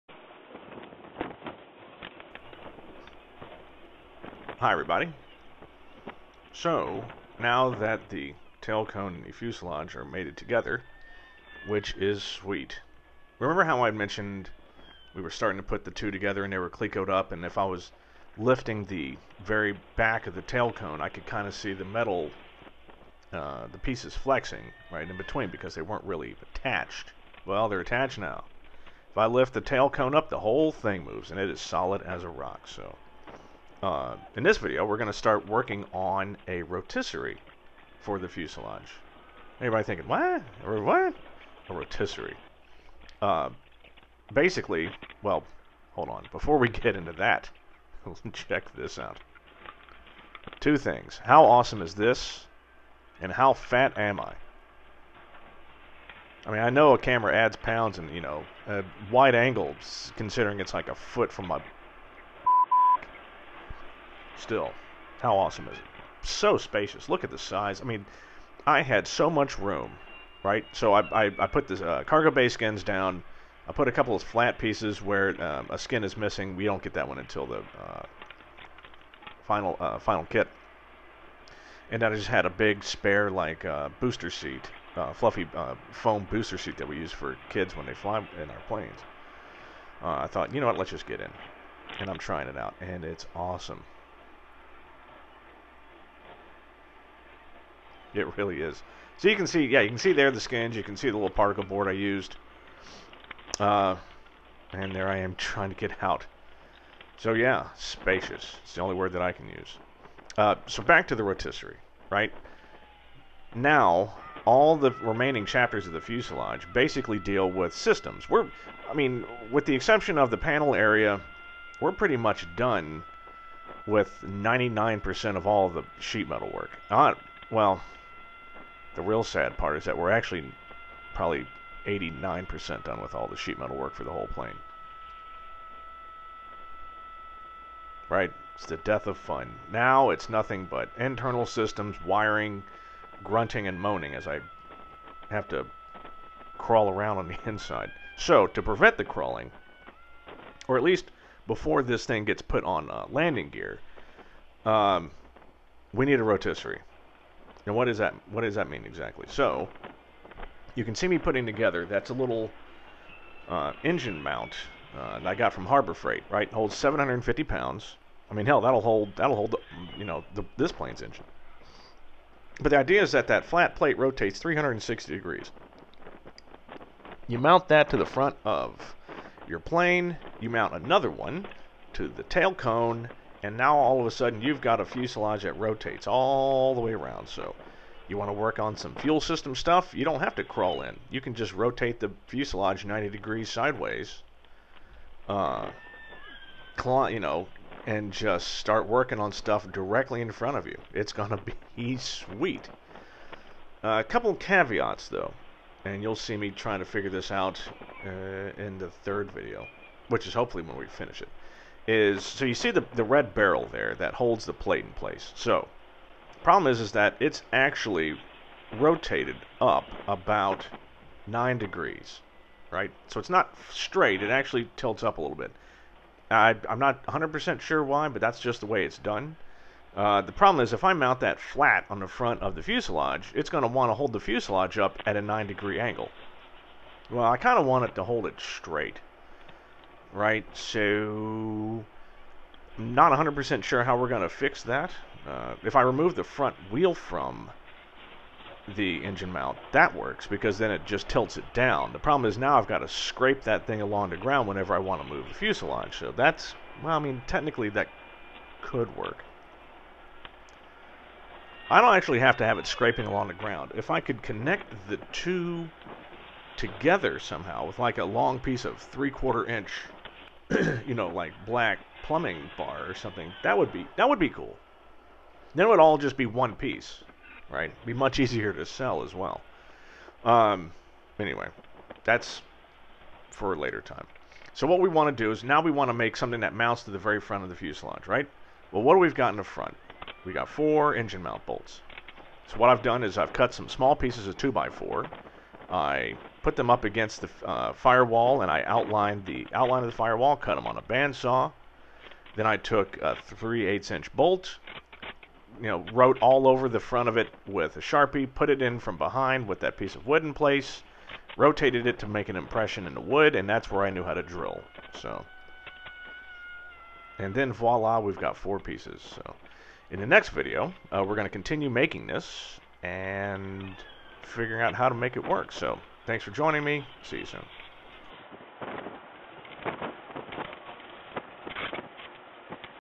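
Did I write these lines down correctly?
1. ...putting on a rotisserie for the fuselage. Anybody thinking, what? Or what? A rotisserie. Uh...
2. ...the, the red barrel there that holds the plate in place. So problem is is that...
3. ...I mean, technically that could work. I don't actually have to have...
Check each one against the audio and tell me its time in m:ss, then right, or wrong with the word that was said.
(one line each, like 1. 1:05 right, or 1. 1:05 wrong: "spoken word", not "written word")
1. 0:35 wrong: "working", not "putting"
2. 3:32 right
3. 4:16 right.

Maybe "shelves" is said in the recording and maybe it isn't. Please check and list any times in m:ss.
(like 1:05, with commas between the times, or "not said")
not said.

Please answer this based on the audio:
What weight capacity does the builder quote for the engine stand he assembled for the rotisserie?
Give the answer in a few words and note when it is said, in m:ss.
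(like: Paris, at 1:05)
750 pounds, at 2:46.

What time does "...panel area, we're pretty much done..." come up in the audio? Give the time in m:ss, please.
2:00.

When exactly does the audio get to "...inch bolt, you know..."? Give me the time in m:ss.
5:03.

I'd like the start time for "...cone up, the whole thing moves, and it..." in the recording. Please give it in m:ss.
0:29.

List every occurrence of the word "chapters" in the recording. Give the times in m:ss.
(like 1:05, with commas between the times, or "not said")
1:55.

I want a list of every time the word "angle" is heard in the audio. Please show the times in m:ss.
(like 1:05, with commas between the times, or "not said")
0:59, 3:55.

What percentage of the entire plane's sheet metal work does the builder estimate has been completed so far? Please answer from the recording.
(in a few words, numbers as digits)
89%.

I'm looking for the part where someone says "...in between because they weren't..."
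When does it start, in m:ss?
0:25.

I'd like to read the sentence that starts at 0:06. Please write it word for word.
So, now that the tail cone and the fuselage are mated together, which is sweet.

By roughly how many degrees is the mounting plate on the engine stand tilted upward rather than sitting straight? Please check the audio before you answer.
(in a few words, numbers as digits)
9 degrees.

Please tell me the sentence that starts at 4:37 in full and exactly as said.
Be much easier to sell as well.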